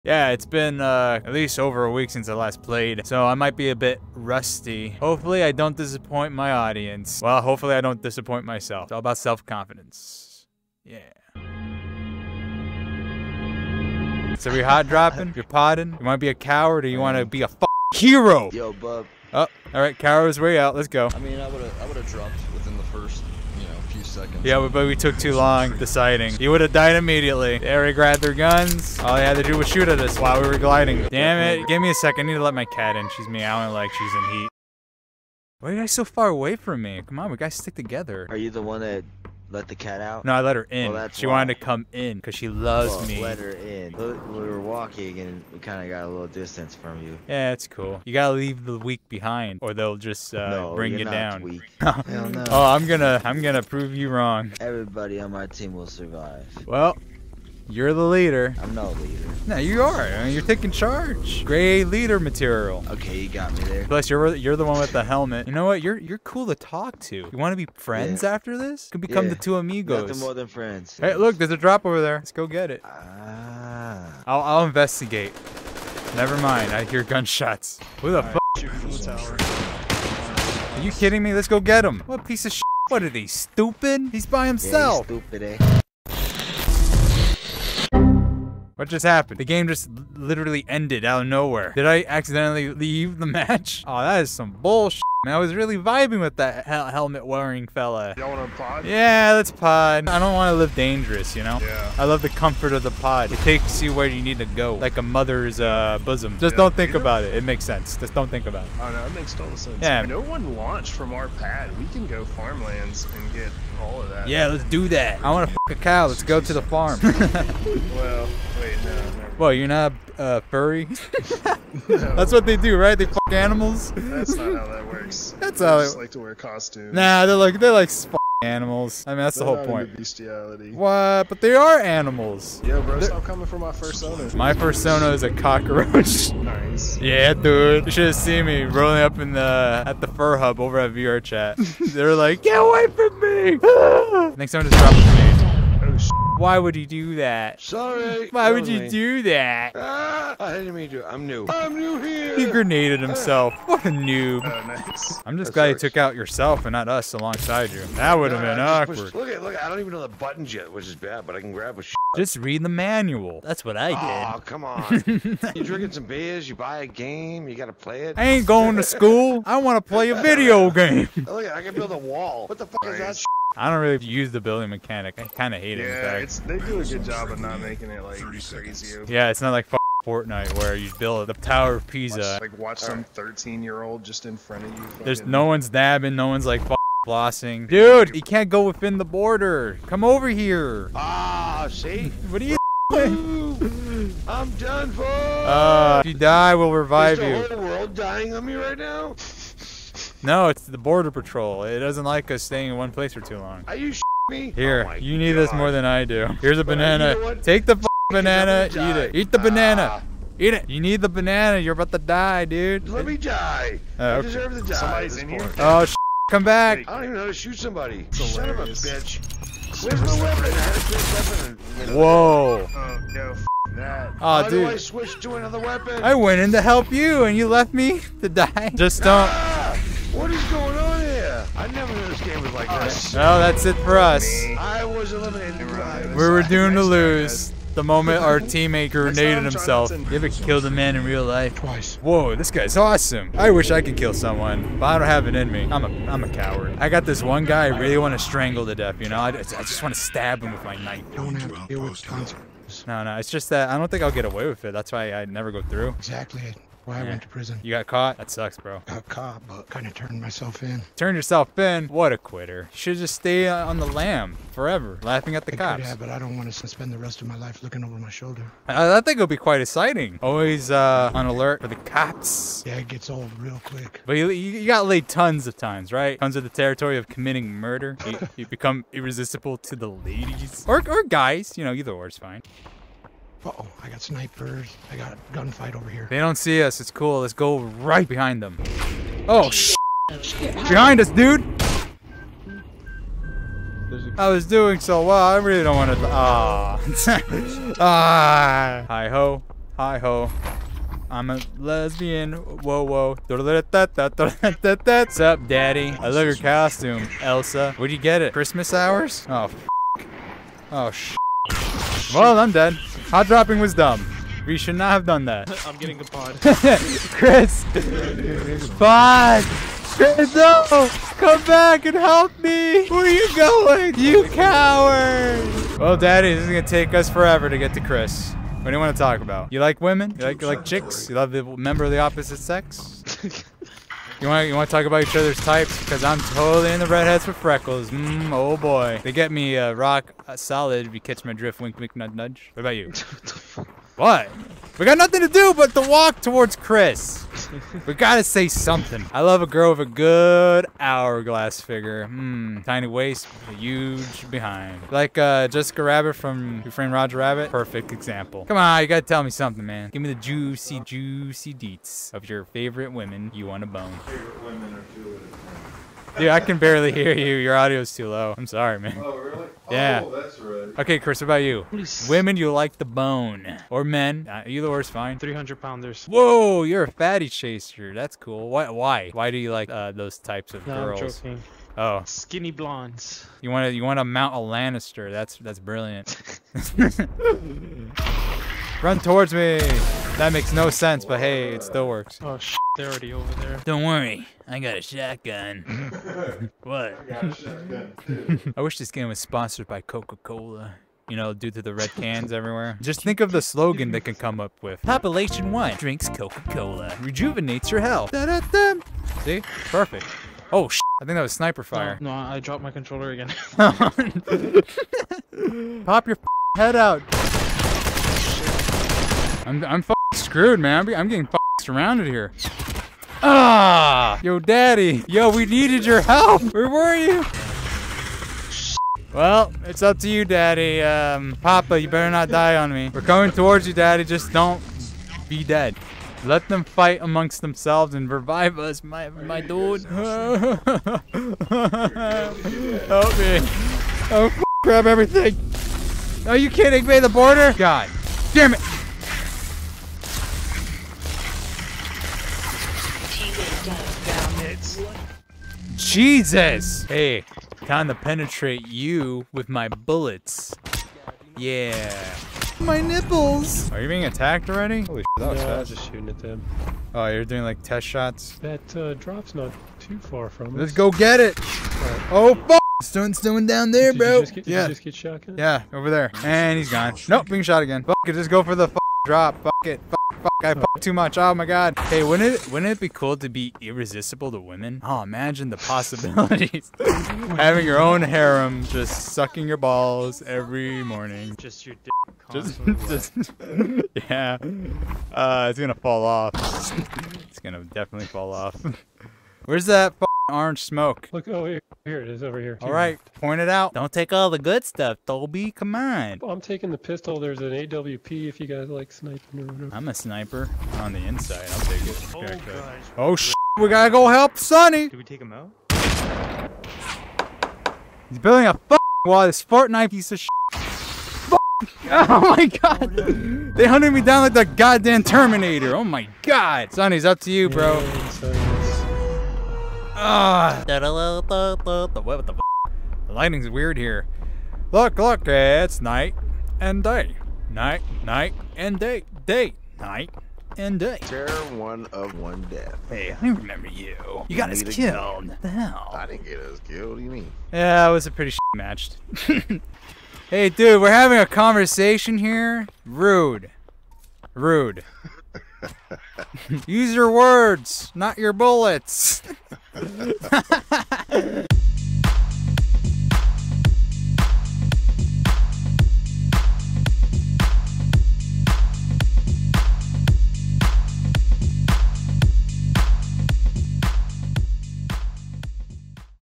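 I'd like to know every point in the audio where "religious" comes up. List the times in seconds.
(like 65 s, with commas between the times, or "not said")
not said.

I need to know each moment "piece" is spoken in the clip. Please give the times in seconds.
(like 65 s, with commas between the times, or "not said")
82 s, 519 s.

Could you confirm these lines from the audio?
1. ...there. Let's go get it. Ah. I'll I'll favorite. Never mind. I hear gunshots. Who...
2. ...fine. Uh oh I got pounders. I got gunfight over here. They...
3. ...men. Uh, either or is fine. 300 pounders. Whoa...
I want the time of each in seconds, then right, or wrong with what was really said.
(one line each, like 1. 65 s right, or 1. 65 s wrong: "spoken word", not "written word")
1. 72 s wrong: "investigate", not "favorite"
2. 282 s wrong: "snipers", not "pounders"
3. 373 s right.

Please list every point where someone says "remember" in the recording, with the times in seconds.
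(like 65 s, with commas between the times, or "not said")
543 s.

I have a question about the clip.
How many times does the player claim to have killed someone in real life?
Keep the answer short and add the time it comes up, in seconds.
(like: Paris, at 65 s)
Twice, at 241 s.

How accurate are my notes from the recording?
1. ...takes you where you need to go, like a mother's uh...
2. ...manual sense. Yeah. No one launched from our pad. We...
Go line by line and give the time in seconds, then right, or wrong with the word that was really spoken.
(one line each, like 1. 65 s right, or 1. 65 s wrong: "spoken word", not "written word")
1. 103 s right
2. 109 s wrong: "total", not "manual".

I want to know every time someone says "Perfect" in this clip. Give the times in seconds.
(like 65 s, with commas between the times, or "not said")
357 s, 409 s.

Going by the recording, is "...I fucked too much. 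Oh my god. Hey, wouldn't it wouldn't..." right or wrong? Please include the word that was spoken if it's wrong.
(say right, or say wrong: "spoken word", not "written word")
right.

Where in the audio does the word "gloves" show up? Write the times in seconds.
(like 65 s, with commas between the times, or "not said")
not said.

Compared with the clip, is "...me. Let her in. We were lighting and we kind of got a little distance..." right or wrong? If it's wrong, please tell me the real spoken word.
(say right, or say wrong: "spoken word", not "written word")
wrong: "walking", not "lighting".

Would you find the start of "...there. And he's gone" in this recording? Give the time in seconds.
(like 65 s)
475 s.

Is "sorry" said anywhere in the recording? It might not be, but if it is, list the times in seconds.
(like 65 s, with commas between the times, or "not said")
147 s, 368 s.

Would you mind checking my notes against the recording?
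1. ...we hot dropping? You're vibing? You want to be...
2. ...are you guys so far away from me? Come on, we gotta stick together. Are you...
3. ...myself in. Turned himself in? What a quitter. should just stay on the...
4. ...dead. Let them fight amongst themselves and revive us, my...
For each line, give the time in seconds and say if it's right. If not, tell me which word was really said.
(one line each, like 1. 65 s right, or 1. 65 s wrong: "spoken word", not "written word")
1. 14 s wrong: "potting", not "vibing"
2. 35 s right
3. 260 s wrong: "yourself", not "himself"
4. 435 s right.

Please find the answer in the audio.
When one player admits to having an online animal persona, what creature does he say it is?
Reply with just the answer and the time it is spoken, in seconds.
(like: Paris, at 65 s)
Cockroach, at 134 s.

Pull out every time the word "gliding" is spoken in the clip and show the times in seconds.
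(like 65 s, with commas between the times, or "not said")
30 s.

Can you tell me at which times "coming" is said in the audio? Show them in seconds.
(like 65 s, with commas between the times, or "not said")
133 s, 433 s.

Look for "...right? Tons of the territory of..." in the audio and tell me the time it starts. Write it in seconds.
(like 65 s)
275 s.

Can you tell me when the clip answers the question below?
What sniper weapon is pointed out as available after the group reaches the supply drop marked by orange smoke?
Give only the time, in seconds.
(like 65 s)
507 s.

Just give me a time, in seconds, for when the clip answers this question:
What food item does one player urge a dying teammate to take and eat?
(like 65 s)
206 s.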